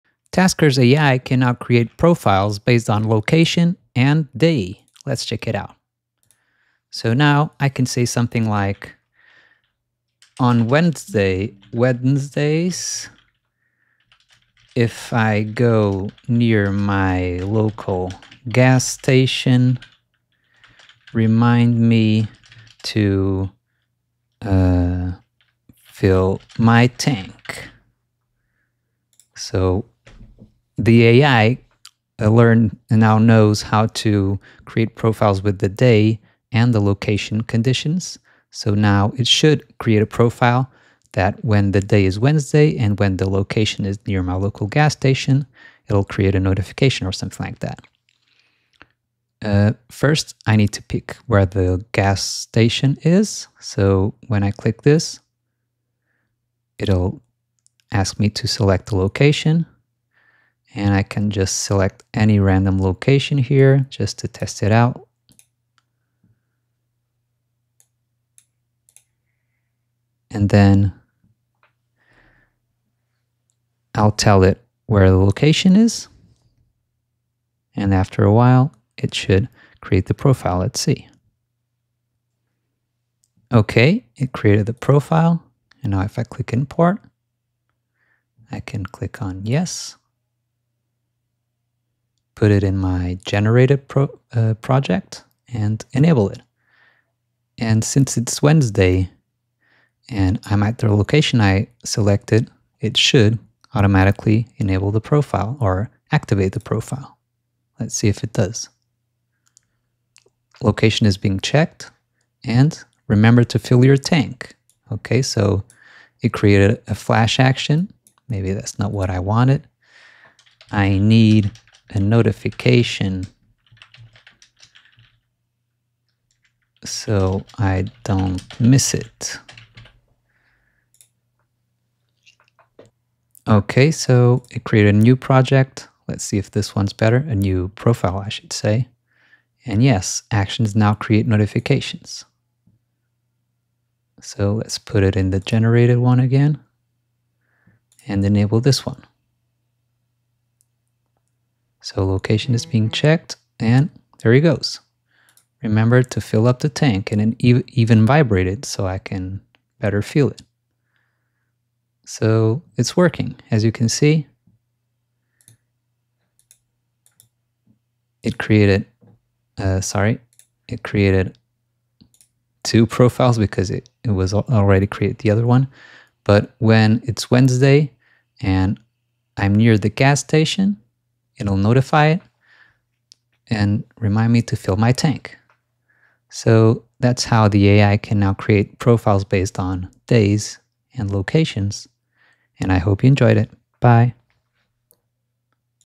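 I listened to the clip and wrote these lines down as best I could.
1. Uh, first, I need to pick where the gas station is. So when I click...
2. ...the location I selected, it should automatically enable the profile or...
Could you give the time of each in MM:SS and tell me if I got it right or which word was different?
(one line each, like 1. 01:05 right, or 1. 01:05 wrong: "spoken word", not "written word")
1. 00:49 right
2. 01:40 right.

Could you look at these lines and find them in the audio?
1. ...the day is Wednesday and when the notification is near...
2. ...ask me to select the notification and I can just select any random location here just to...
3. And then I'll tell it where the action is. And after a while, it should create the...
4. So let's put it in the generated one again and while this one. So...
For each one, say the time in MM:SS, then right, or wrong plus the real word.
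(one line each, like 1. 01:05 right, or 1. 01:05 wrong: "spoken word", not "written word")
1. 00:41 wrong: "location", not "notification"
2. 00:57 wrong: "location", not "notification"
3. 01:10 wrong: "location", not "action"
4. 02:24 wrong: "enable", not "while".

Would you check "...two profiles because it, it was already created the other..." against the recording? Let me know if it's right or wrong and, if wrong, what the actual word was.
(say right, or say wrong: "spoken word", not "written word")
right.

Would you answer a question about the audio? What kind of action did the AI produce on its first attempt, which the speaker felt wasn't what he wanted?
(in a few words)
Flash action.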